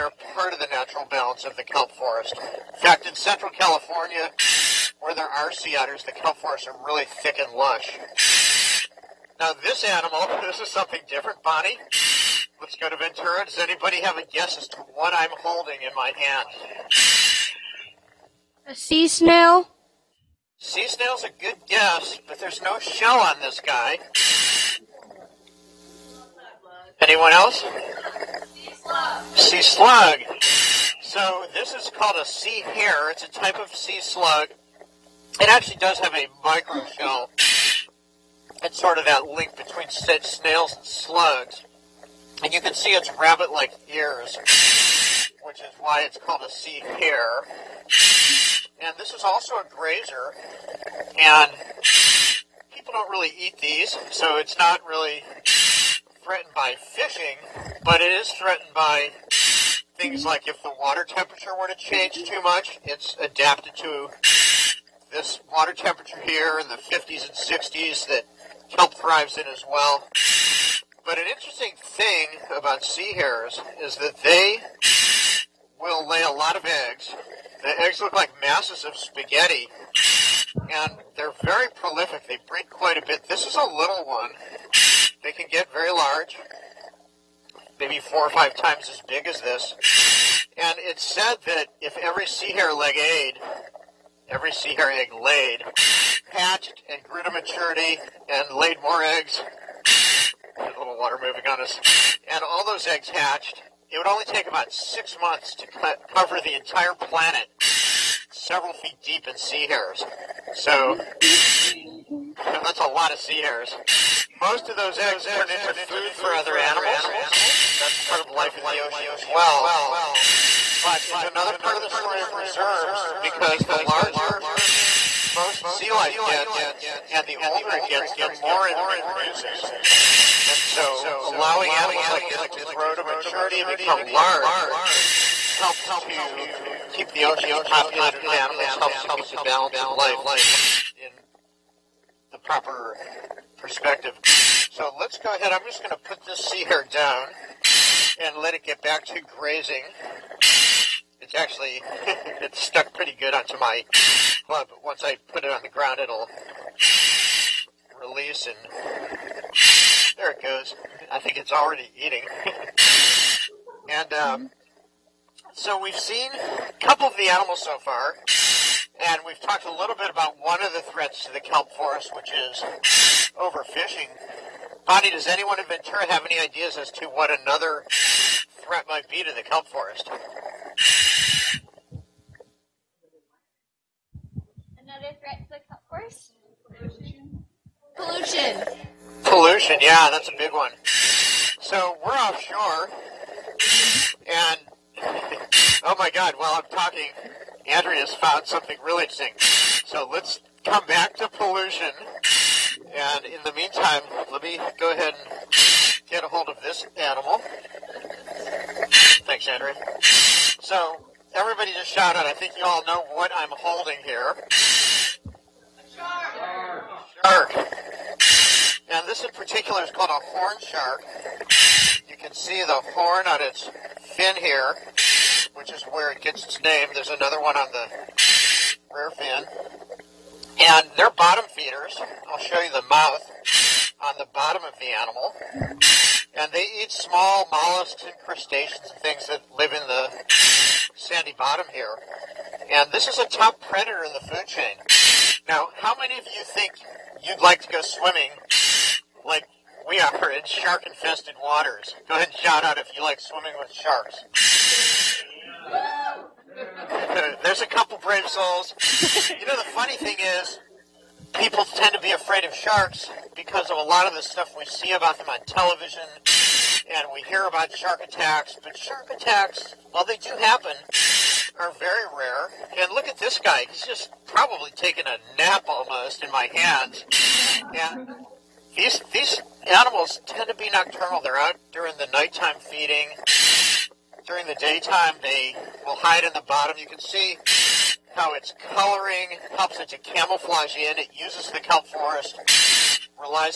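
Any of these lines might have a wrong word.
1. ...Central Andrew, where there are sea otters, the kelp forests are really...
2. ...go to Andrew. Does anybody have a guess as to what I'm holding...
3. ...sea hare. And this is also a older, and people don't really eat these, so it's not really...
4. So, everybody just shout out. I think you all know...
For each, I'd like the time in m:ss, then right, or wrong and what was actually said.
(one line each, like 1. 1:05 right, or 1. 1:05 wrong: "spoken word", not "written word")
1. 0:03 wrong: "California", not "Andrew"
2. 0:12 wrong: "Ventura", not "Andrew"
3. 0:46 wrong: "grazer", not "older"
4. 3:30 right.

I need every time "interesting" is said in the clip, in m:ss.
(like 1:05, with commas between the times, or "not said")
1:11, 3:19.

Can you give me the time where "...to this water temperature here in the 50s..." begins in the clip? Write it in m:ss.
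1:03.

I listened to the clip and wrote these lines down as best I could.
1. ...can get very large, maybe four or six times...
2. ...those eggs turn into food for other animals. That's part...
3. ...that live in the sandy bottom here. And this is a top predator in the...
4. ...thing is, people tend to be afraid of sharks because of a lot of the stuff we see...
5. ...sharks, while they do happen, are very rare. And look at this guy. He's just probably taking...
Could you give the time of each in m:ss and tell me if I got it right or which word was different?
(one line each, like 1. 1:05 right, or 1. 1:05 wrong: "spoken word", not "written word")
1. 1:25 wrong: "five", not "six"
2. 1:54 right
3. 3:59 right
4. 4:19 right
5. 4:29 wrong: "attacks", not "sharks".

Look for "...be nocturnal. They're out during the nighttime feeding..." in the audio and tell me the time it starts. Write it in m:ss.
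4:40.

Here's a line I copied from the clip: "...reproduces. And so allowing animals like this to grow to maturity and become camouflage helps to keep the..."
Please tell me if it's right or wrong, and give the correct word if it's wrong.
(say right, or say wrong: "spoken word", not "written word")
wrong: "large", not "camouflage".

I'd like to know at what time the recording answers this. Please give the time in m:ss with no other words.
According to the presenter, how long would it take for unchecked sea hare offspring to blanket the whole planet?
1:44.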